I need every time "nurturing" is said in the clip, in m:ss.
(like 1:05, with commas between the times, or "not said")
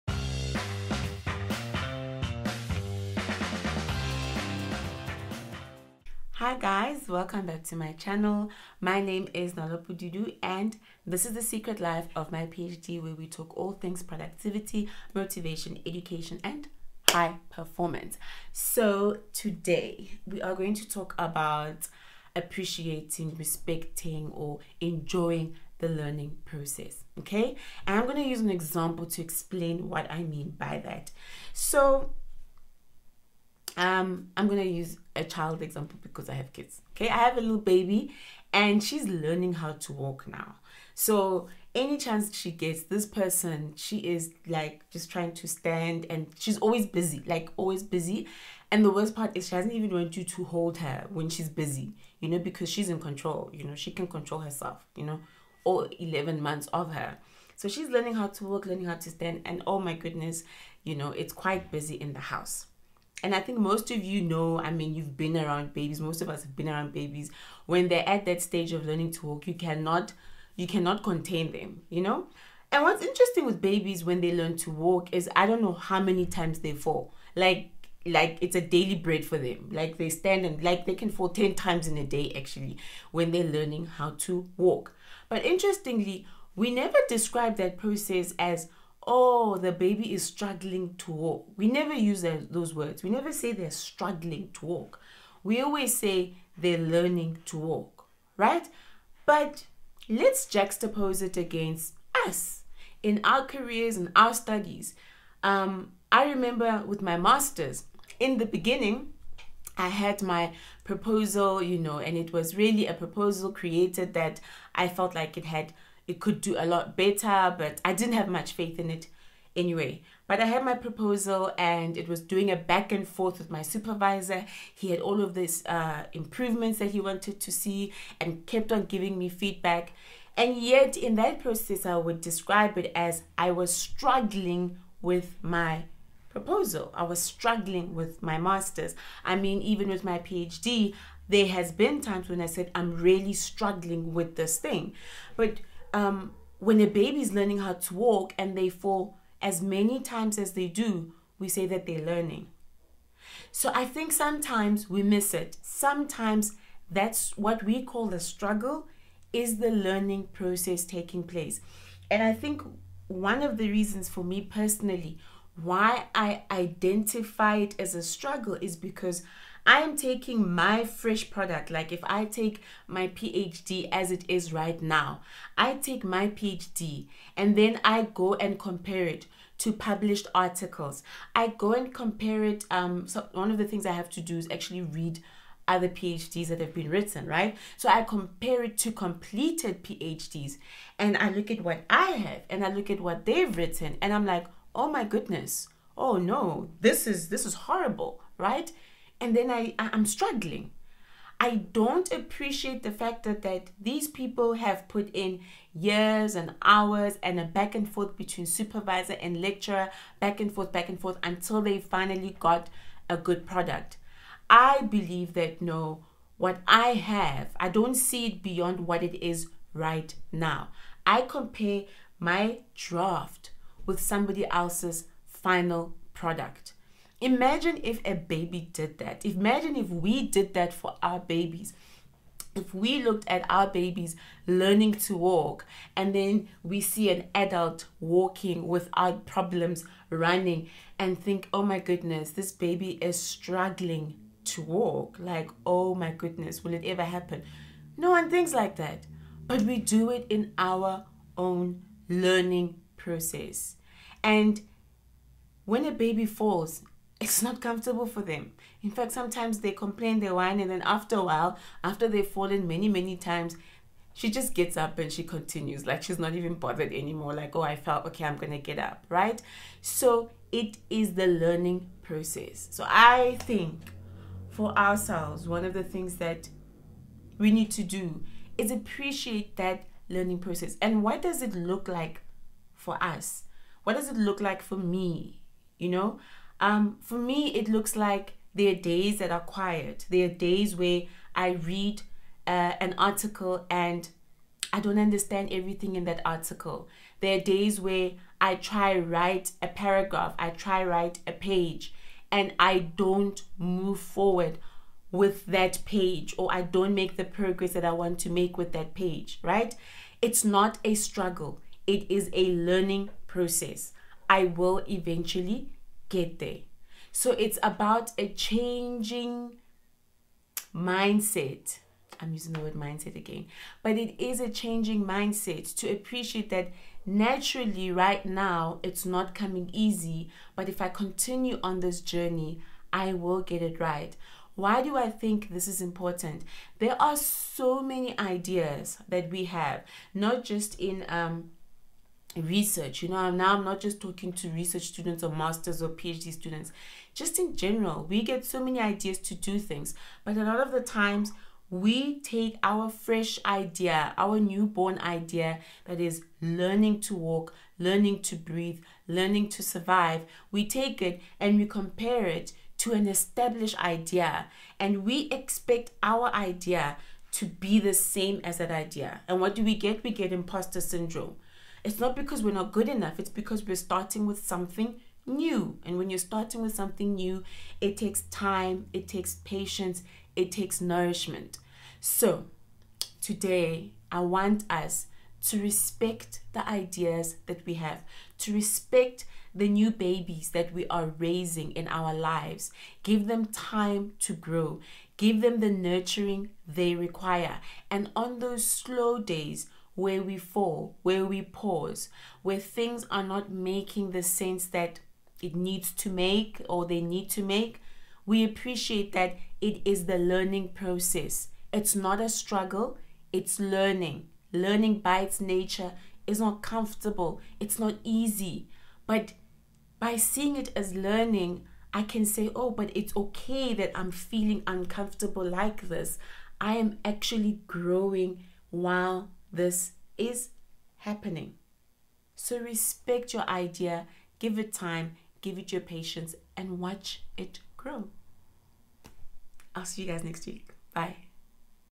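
6:35.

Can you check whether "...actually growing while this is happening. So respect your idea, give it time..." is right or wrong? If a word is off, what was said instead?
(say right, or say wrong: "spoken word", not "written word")
right.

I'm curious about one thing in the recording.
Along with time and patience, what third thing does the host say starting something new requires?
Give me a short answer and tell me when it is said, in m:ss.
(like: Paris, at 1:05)
nourishment, at 6:20.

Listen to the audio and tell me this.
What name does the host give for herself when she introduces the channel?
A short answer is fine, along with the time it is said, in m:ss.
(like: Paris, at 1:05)
Nolo Pududu, at 0:09.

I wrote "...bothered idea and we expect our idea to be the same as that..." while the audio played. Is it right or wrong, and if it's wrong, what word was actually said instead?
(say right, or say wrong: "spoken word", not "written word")
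wrong: "established", not "bothered".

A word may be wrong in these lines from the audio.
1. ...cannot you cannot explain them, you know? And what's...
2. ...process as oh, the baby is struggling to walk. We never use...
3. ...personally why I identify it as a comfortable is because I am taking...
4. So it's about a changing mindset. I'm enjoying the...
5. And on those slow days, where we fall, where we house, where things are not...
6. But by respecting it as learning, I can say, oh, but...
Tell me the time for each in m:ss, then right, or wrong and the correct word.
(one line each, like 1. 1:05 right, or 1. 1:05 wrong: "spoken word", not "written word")
1. 1:09 wrong: "contain", not "explain"
2. 1:27 right
3. 2:44 wrong: "struggle", not "comfortable"
4. 5:17 wrong: "using", not "enjoying"
5. 6:37 wrong: "pause", not "house"
6. 6:59 wrong: "seeing", not "respecting".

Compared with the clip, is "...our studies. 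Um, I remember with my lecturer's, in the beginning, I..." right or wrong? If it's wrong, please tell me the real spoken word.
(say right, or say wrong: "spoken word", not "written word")
wrong: "master", not "lecturer".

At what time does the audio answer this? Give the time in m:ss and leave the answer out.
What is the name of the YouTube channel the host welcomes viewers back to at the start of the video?
0:11.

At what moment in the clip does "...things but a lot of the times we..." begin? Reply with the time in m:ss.
5:49.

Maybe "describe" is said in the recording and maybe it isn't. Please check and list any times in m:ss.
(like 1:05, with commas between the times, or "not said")
1:27, 2:12.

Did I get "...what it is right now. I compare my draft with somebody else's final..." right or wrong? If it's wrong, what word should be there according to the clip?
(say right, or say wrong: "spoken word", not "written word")
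right.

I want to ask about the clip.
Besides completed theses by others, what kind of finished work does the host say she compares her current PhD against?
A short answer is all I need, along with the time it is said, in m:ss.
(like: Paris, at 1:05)
published articles, at 2:59.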